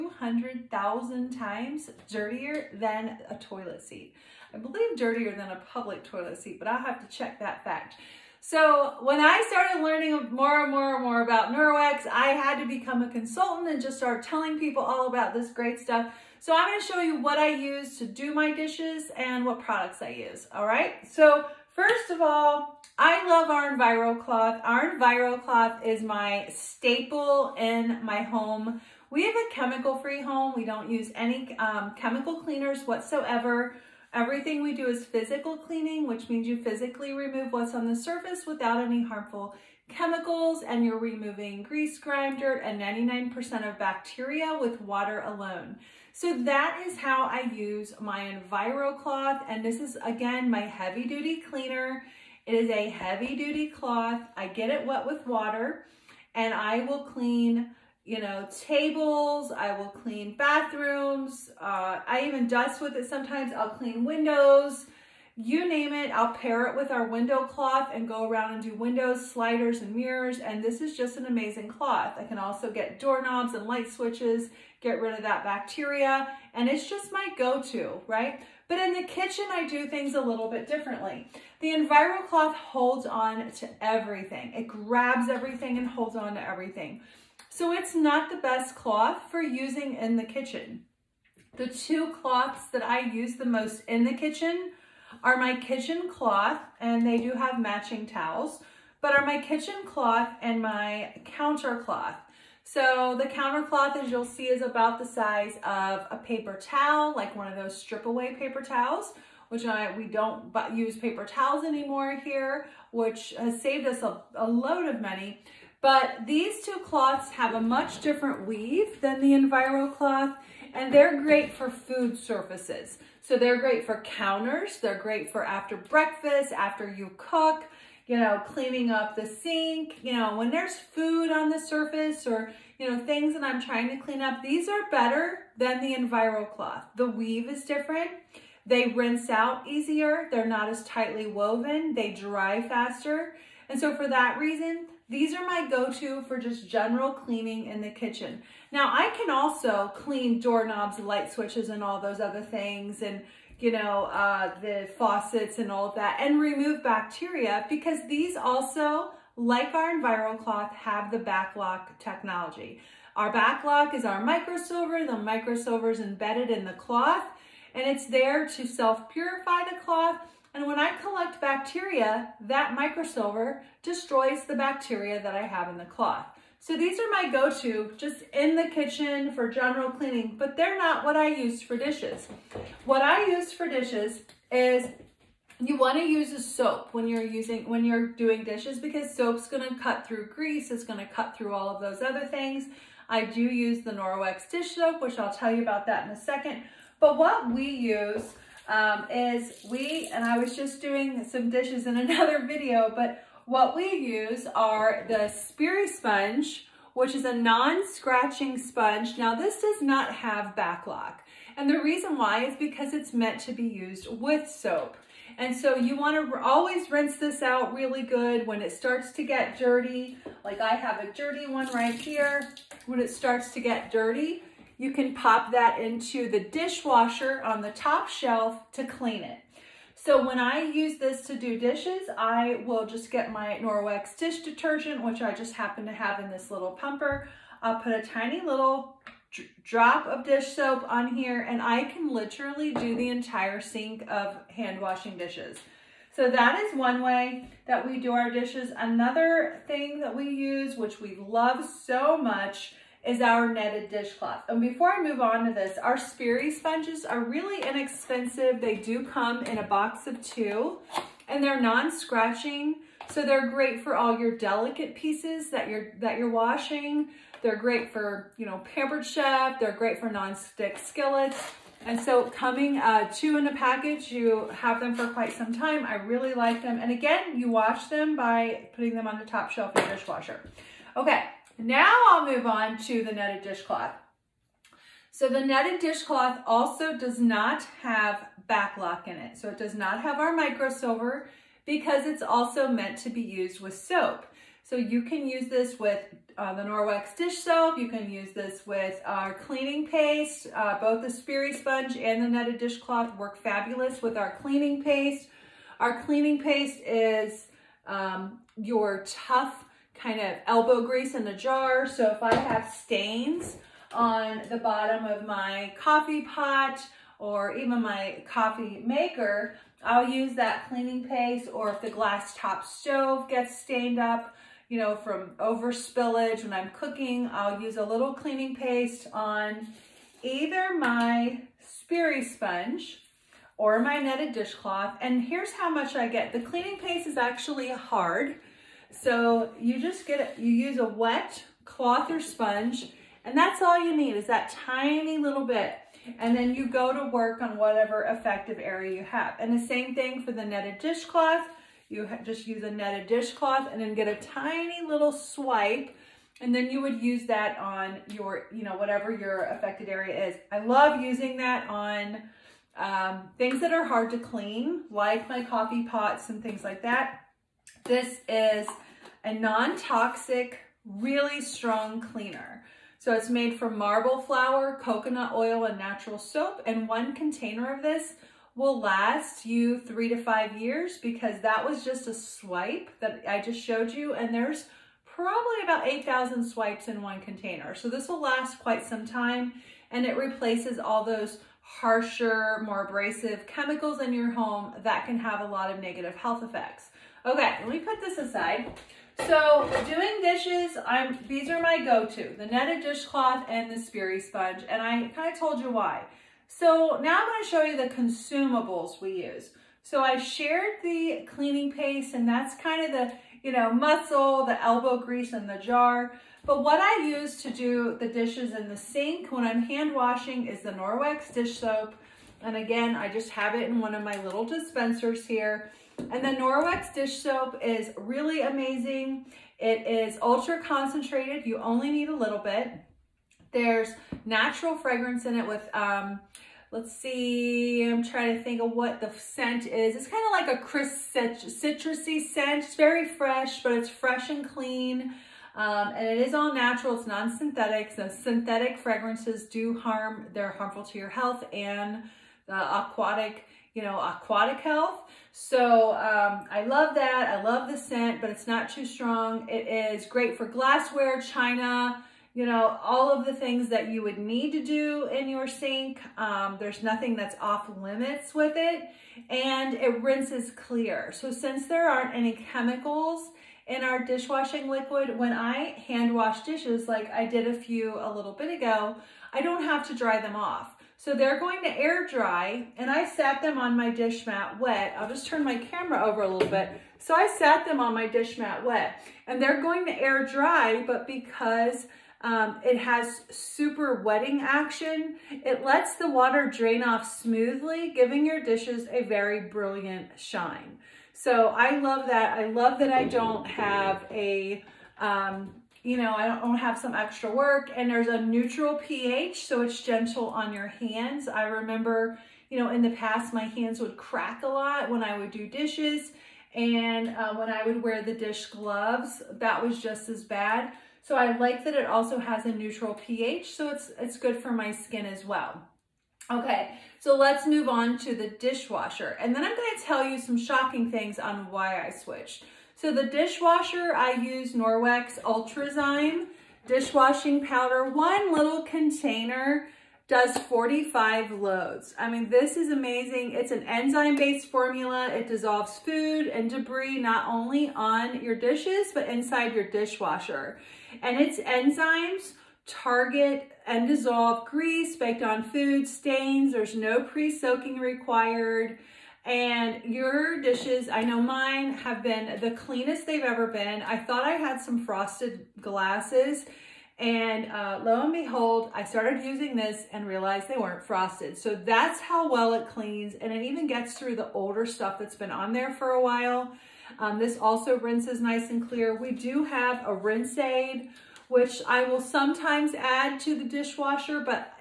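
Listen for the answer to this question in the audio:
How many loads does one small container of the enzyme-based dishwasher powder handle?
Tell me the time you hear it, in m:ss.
9:00.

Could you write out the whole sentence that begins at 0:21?
So First of all, I love our Enviro cloth.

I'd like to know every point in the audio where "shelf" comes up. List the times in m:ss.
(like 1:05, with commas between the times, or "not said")
3:48, 4:39.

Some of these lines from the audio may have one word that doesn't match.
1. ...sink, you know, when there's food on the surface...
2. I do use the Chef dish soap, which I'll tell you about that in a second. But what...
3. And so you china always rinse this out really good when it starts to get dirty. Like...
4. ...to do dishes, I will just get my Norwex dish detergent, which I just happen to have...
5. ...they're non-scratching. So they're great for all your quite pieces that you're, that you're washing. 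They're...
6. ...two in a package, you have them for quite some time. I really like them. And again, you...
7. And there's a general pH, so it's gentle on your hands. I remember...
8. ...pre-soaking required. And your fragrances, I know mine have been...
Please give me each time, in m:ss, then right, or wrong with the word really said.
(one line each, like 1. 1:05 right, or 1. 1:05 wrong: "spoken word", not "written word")
1. 2:09 right
2. 3:13 wrong: "Norwex", not "Chef"
3. 3:35 wrong: "wanna", not "china"
4. 3:51 right
5. 4:21 wrong: "delicate", not "quite"
6. 4:33 right
7. 8:27 wrong: "neutral", not "general"
8. 9:17 wrong: "dishes", not "fragrances".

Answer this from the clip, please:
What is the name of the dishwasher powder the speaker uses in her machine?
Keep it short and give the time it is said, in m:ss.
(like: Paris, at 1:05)
Ultrazyme, at 8:55.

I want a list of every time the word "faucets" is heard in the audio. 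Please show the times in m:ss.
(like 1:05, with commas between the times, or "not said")
2:34.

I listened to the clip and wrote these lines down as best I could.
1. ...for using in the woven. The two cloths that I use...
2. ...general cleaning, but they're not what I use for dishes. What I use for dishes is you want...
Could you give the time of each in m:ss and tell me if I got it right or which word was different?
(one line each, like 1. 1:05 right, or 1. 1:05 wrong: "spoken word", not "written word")
1. 1:29 wrong: "kitchen", not "woven"
2. 2:59 right.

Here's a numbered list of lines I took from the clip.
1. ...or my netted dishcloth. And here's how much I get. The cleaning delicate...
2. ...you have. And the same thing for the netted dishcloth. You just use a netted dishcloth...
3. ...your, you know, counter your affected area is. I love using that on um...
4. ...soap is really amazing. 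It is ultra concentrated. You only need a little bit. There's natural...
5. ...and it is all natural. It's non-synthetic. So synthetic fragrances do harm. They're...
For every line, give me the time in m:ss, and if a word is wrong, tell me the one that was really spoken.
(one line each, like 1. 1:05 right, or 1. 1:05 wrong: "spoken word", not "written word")
1. 5:33 wrong: "paste", not "delicate"
2. 5:48 right
3. 5:58 wrong: "whatever", not "counter"
4. 7:07 right
5. 7:25 right.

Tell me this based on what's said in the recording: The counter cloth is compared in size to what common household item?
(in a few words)
a paper towel.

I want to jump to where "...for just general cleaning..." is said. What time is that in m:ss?
2:26.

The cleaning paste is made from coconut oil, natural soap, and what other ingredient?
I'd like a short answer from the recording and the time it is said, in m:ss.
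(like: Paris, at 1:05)
marble flour, at 6:13.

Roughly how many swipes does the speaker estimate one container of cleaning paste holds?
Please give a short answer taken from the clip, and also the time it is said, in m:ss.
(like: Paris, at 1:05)
8,000, at 6:25.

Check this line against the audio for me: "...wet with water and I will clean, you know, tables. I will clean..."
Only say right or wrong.
right.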